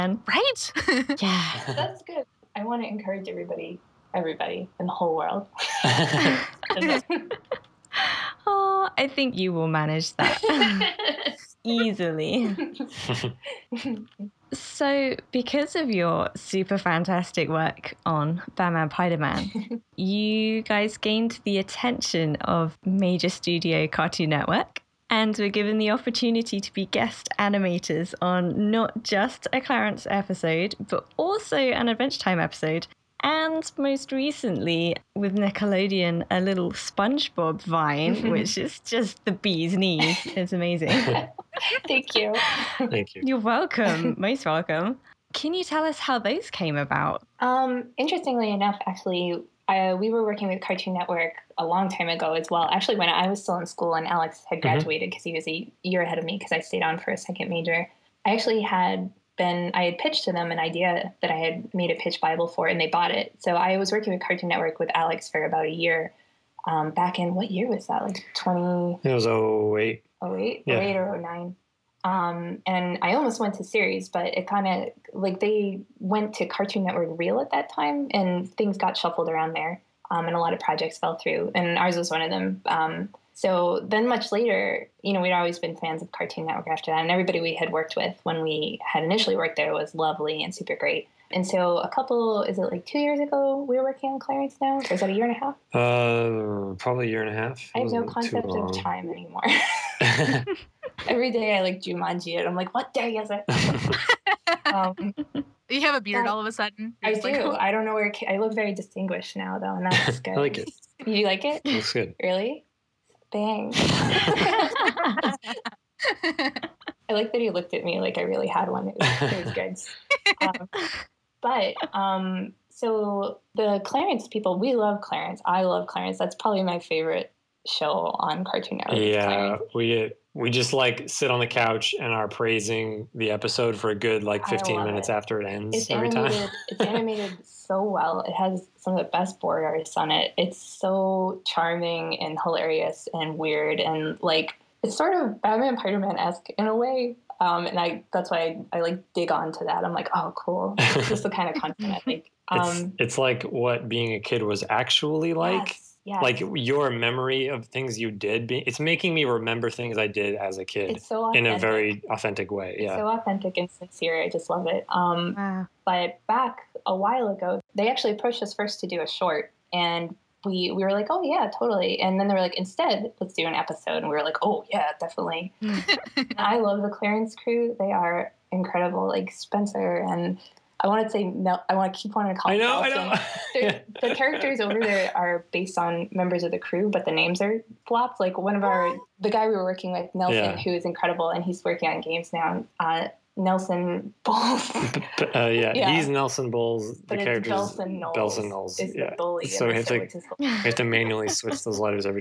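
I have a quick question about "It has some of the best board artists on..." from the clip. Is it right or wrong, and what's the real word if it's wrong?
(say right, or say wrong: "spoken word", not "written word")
right.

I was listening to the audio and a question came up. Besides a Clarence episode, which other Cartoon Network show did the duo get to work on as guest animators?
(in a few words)
Adventure Time.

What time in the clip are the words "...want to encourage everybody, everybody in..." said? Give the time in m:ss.
0:02.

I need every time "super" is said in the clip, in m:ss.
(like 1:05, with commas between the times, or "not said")
0:16, 1:30.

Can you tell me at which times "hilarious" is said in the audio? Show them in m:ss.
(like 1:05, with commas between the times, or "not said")
2:22.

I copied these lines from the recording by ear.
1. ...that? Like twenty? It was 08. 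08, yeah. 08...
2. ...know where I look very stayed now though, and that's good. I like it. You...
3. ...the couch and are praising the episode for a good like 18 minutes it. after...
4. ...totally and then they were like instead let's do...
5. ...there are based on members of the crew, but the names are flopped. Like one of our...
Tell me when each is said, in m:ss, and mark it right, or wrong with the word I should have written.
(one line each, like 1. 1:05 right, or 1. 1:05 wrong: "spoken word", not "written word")
1. 1:07 right
2. 1:47 wrong: "distinguished", not "stayed"
3. 2:11 wrong: "15", not "18"
4. 2:51 right
5. 3:04 right.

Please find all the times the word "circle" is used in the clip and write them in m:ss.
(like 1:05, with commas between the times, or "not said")
not said.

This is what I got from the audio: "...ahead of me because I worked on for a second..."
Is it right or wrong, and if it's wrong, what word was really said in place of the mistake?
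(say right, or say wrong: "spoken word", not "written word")
wrong: "stayed", not "worked".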